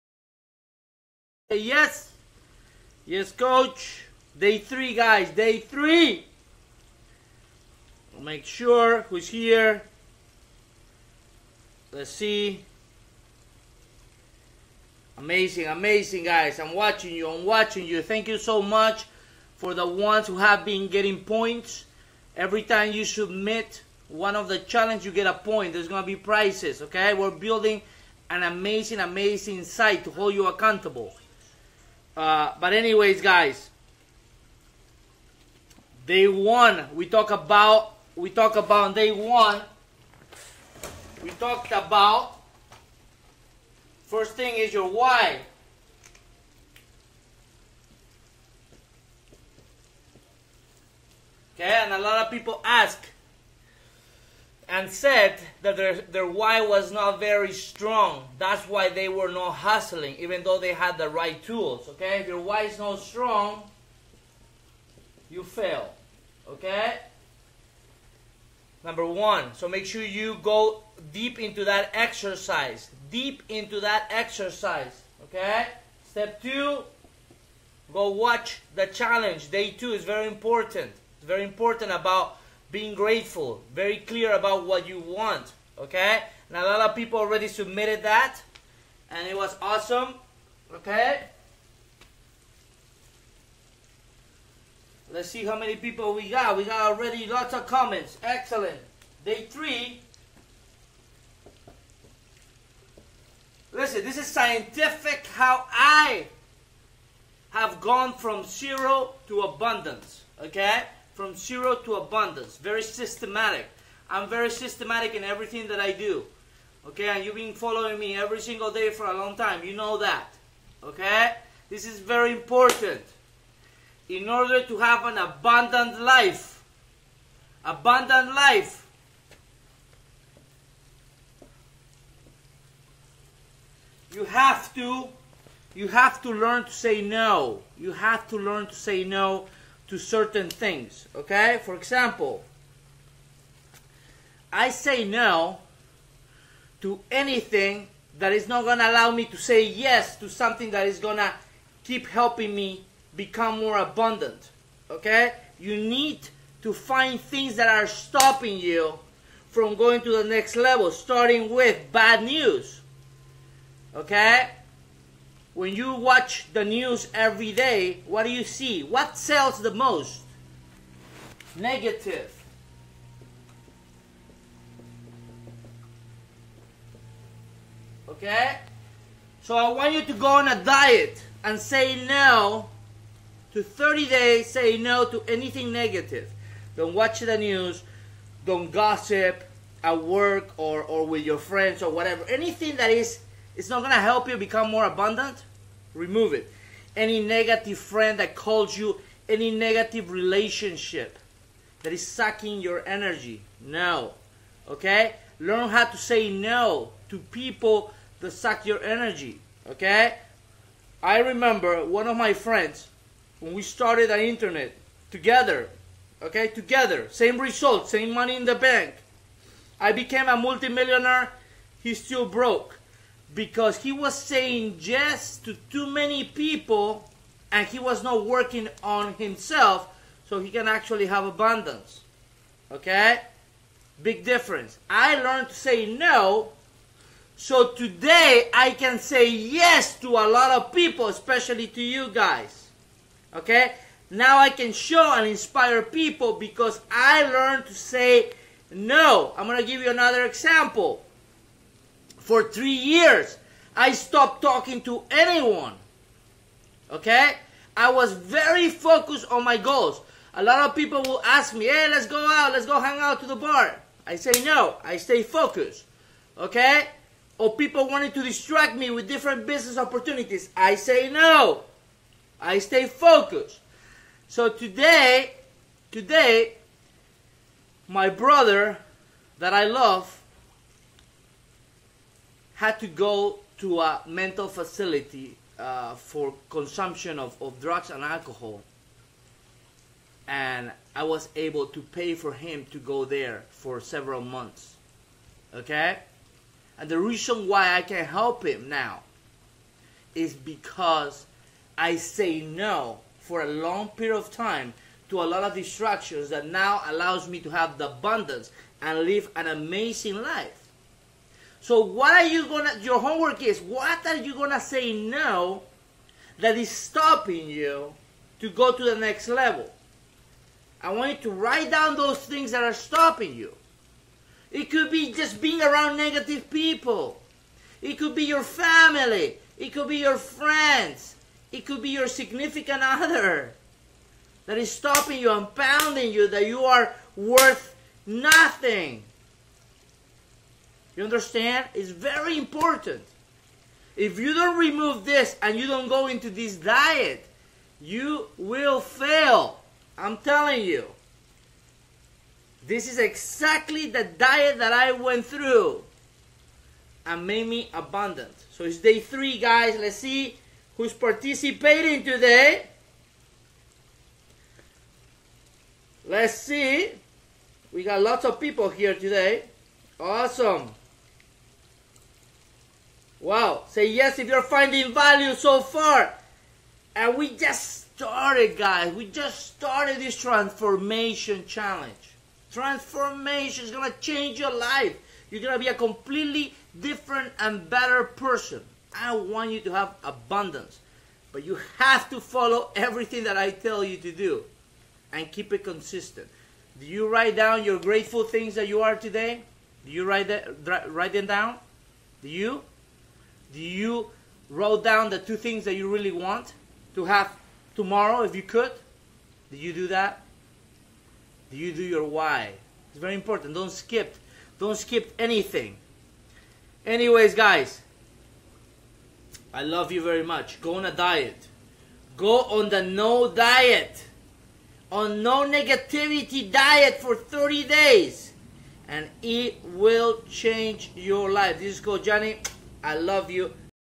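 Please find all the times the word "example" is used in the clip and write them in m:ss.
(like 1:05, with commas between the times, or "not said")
2:21, 4:10.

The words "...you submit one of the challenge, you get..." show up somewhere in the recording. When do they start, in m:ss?
0:22.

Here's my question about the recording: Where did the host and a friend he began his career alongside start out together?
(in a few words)
The internet.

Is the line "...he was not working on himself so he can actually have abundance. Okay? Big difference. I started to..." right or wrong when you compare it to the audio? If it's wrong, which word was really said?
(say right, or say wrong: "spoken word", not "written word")
wrong: "learned", not "started".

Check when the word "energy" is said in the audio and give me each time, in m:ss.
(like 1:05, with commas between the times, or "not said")
3:22, 3:28.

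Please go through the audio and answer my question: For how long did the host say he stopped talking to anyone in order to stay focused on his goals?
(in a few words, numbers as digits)
3 years.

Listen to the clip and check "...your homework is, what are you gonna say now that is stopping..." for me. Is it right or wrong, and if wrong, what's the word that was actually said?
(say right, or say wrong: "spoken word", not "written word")
right.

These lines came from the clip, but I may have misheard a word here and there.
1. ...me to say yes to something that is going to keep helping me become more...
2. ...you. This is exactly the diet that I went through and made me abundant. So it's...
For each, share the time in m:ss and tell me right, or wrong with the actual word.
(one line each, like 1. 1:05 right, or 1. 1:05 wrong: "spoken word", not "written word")
1. 2:29 right
2. 5:50 right.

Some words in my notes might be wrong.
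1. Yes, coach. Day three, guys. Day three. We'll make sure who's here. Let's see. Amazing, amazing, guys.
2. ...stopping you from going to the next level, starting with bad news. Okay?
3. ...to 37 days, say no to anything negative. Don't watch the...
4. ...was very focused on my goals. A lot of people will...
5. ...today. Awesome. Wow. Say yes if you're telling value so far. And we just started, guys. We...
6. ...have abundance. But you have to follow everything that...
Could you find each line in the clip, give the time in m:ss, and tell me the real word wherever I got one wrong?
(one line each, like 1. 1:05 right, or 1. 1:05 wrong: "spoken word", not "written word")
1. 0:03 right
2. 2:37 right
3. 3:03 wrong: "30", not "37"
4. 4:17 right
5. 6:08 wrong: "finding", not "telling"
6. 6:29 right.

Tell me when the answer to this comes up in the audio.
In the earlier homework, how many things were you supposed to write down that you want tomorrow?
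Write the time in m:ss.
6:45.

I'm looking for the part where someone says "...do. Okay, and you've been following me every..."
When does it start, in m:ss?
1:55.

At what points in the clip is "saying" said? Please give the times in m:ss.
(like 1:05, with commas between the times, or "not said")
3:44.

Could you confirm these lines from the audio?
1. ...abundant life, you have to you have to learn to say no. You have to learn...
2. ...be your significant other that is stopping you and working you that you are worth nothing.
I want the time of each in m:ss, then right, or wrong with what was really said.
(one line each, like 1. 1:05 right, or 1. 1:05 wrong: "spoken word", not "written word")
1. 2:07 right
2. 5:31 wrong: "pounding", not "working".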